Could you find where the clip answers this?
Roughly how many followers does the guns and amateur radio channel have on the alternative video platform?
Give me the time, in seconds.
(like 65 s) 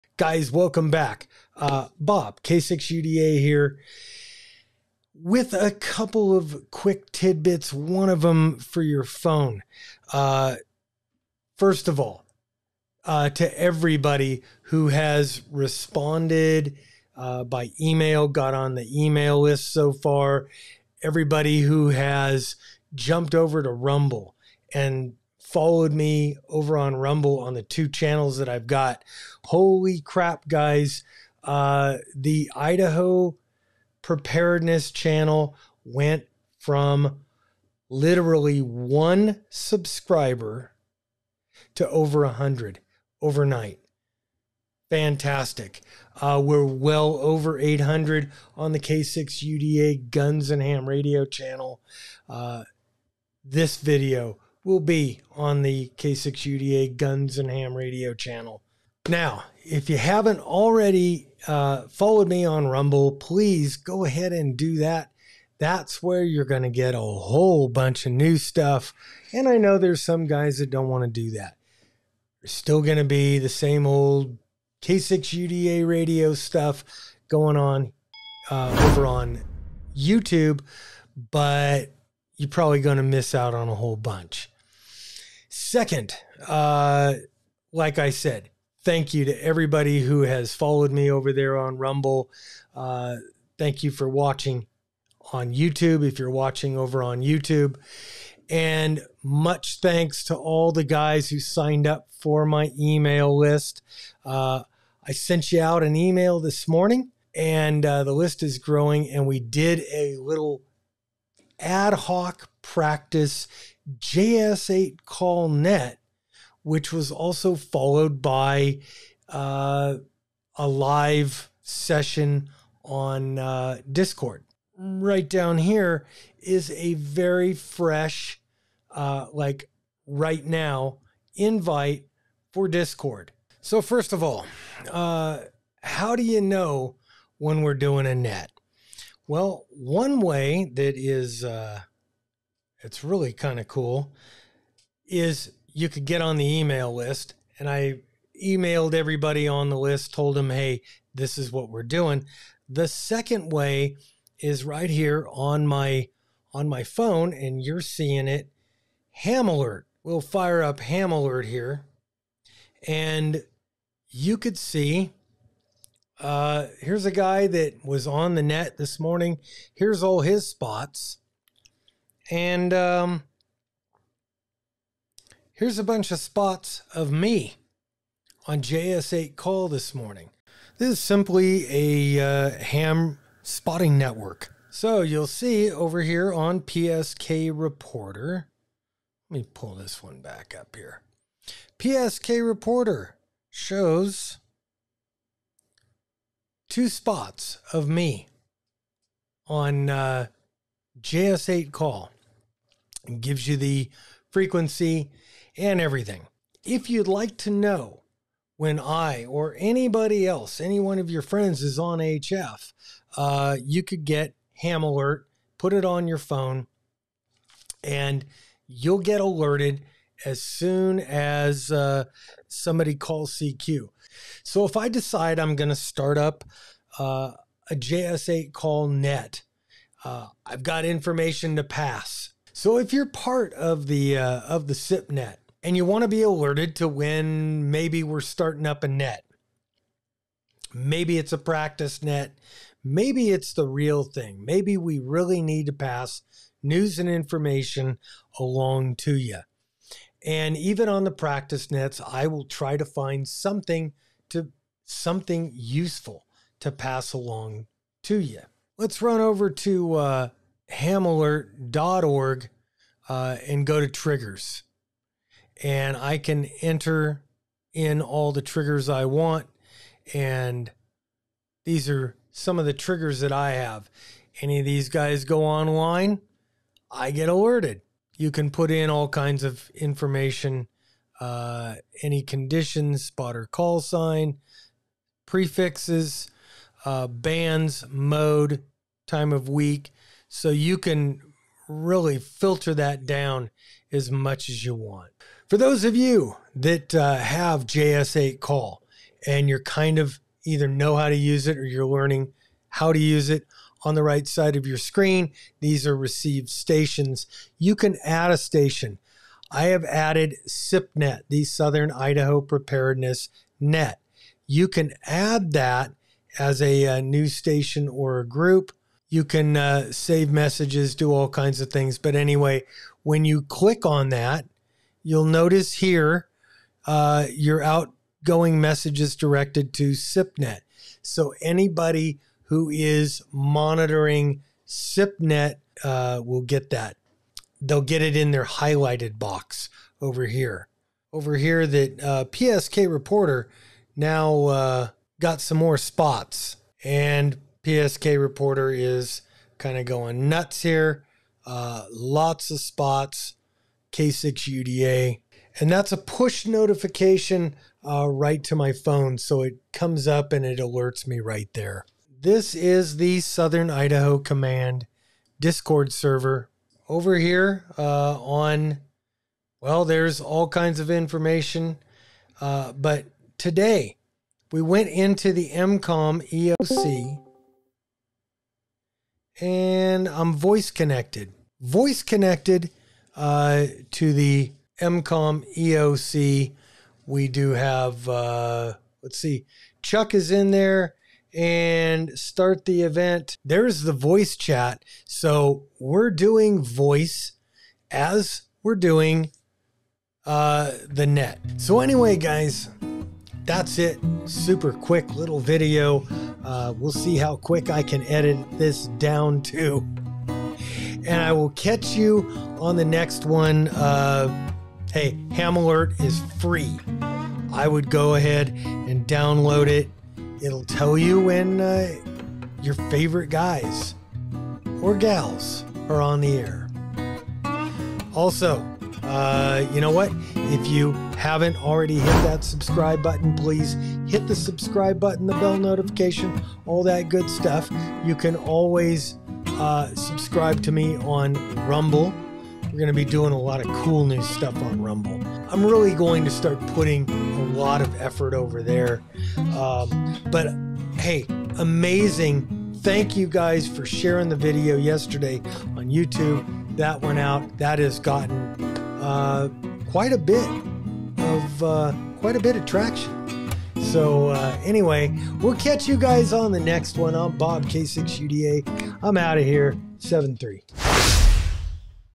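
46 s.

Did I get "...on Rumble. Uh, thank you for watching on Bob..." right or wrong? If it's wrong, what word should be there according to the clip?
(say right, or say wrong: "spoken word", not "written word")
wrong: "YouTube", not "Bob".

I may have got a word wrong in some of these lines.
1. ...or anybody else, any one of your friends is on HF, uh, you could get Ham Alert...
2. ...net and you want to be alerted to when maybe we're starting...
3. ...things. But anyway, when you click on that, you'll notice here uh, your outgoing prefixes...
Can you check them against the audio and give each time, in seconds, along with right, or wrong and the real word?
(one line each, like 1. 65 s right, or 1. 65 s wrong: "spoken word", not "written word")
1. 209 s right
2. 235 s right
3. 321 s wrong: "messages", not "prefixes".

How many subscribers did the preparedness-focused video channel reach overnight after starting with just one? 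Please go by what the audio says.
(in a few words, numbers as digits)
Over 100.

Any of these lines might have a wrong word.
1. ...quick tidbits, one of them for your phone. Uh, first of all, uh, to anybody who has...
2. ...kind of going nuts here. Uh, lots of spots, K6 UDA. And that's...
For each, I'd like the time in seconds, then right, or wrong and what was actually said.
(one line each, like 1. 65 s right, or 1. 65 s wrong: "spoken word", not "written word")
1. 6 s wrong: "everybody", not "anybody"
2. 349 s right.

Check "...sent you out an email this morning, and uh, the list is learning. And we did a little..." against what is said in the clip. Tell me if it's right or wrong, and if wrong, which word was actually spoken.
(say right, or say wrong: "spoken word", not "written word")
wrong: "growing", not "learning".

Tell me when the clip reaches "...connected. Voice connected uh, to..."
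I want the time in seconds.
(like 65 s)
380 s.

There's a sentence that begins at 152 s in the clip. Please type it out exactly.
The second way is right here on my on my phone, and you're seeing it.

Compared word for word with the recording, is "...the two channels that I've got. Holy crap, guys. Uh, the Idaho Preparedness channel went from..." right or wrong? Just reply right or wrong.
right.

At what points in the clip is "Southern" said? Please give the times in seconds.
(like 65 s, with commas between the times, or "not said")
311 s, 363 s.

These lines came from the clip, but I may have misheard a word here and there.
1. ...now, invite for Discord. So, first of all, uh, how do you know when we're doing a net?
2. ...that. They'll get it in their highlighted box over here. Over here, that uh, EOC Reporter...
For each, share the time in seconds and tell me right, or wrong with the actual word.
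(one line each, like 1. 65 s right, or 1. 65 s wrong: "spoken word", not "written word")
1. 130 s right
2. 336 s wrong: "PSK", not "EOC".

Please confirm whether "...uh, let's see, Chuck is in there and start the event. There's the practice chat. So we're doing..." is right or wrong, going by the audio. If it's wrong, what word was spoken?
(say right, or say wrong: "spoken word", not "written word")
wrong: "voice", not "practice".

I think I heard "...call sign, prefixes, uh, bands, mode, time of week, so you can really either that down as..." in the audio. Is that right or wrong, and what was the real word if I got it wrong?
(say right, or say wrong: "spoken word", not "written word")
wrong: "filter", not "either".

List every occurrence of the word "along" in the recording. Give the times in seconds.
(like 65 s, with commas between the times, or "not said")
248 s, 257 s.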